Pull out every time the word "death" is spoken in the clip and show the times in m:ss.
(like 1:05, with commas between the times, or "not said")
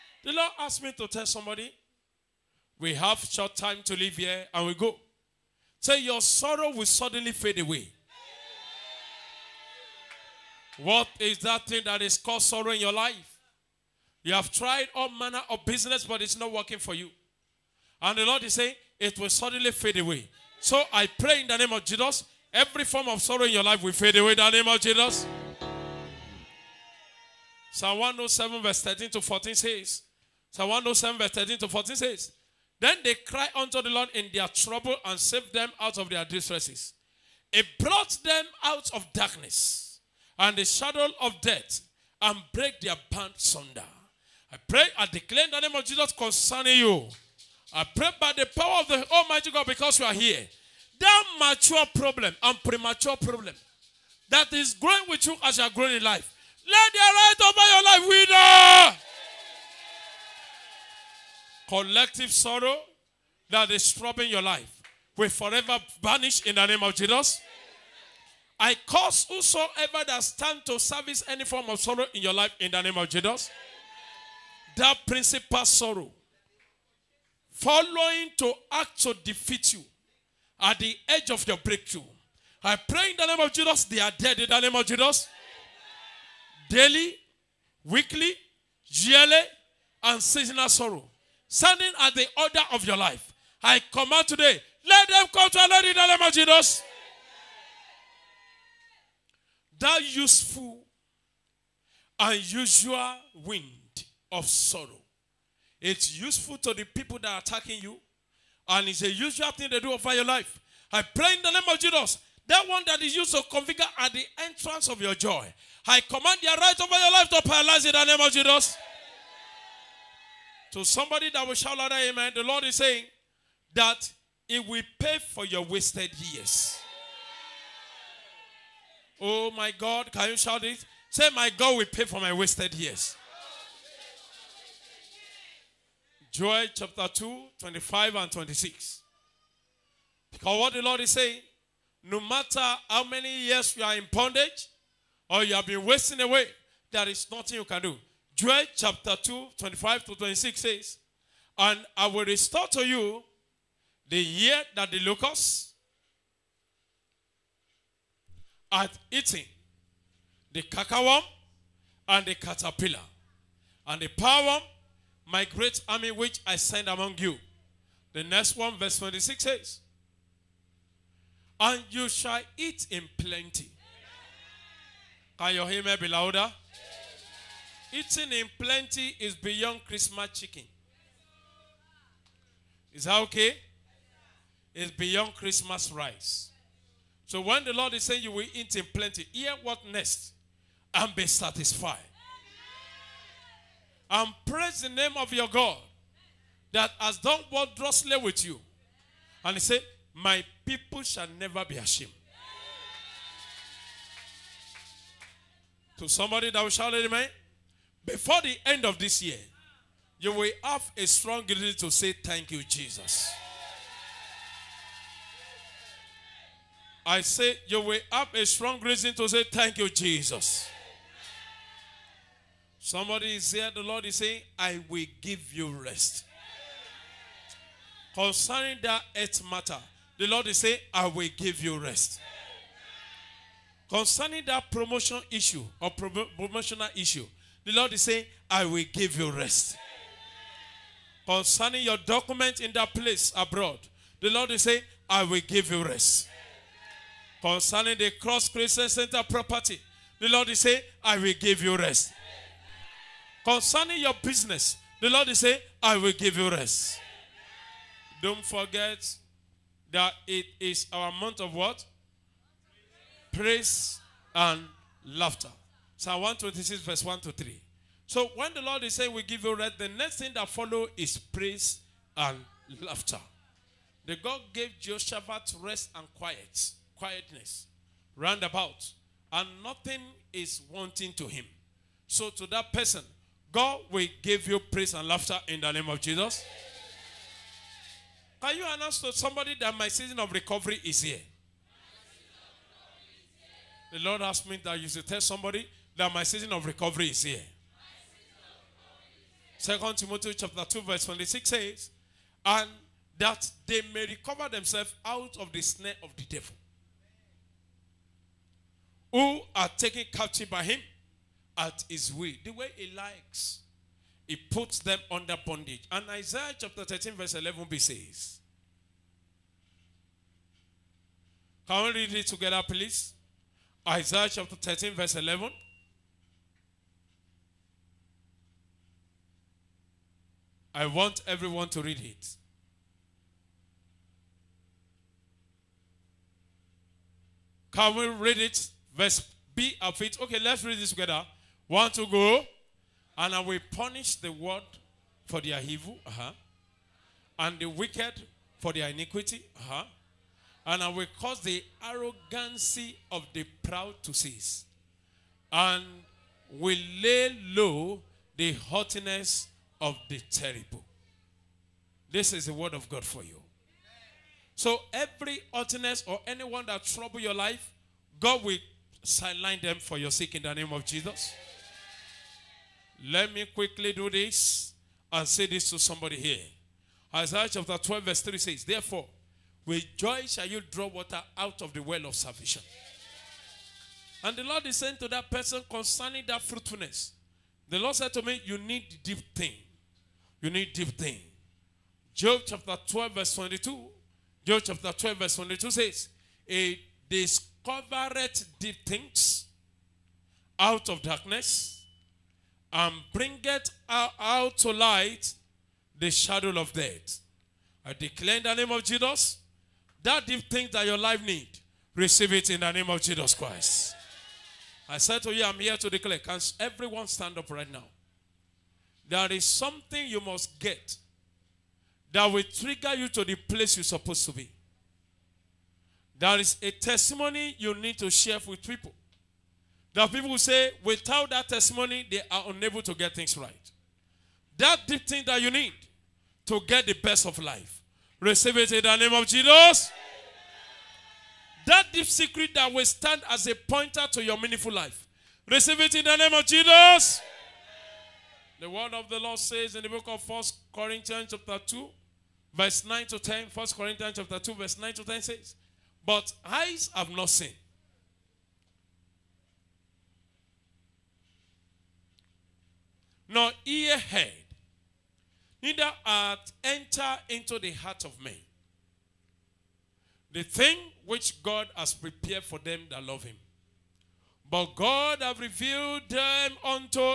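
0:41, 6:46.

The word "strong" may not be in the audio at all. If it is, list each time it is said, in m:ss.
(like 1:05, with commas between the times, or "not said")
3:31, 3:38.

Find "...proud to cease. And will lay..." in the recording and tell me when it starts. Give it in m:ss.
5:53.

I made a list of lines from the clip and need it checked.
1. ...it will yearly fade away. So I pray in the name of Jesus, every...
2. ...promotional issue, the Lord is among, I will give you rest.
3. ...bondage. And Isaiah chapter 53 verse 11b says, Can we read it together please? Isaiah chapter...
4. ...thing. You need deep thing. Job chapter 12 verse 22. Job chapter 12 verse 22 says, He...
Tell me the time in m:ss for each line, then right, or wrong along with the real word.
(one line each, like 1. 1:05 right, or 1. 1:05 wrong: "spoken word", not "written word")
1. 0:18 wrong: "suddenly", not "yearly"
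2. 3:56 wrong: "saying", not "among"
3. 5:15 wrong: "13", not "53"
4. 6:29 right.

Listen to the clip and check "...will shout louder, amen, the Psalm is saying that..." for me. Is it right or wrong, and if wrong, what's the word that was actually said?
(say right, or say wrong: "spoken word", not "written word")
wrong: "Lord", not "Psalm".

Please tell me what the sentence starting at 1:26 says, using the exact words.
Daily, weekly, yearly, and seasonal sorrow standing at the order of your life.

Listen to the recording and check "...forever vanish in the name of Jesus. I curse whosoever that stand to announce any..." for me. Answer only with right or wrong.
wrong.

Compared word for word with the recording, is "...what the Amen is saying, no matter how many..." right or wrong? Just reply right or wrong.
wrong.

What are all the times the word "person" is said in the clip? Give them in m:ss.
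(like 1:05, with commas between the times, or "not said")
4:42, 6:25.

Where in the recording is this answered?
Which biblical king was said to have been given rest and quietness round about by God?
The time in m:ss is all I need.
4:34.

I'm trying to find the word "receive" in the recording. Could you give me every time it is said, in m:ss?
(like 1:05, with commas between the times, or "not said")
6:51, 7:18, 7:25.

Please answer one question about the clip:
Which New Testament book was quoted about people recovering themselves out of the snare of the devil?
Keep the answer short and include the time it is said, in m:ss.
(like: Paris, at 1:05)
Second Timothy, at 4:59.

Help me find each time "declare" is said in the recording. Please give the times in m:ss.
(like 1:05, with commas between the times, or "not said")
0:45, 6:47, 6:55.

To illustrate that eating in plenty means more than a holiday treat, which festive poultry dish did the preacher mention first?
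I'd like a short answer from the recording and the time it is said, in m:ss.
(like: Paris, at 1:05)
Christmas chicken, at 2:59.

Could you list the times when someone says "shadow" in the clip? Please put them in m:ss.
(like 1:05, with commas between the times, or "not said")
0:40, 6:46.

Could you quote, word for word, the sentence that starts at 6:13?
Let me quickly do this and say this to somebody here.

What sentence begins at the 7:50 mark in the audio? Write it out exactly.
The thing which God has prepared for them that love him.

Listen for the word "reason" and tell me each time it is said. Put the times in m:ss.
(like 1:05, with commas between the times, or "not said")
3:31, 3:38.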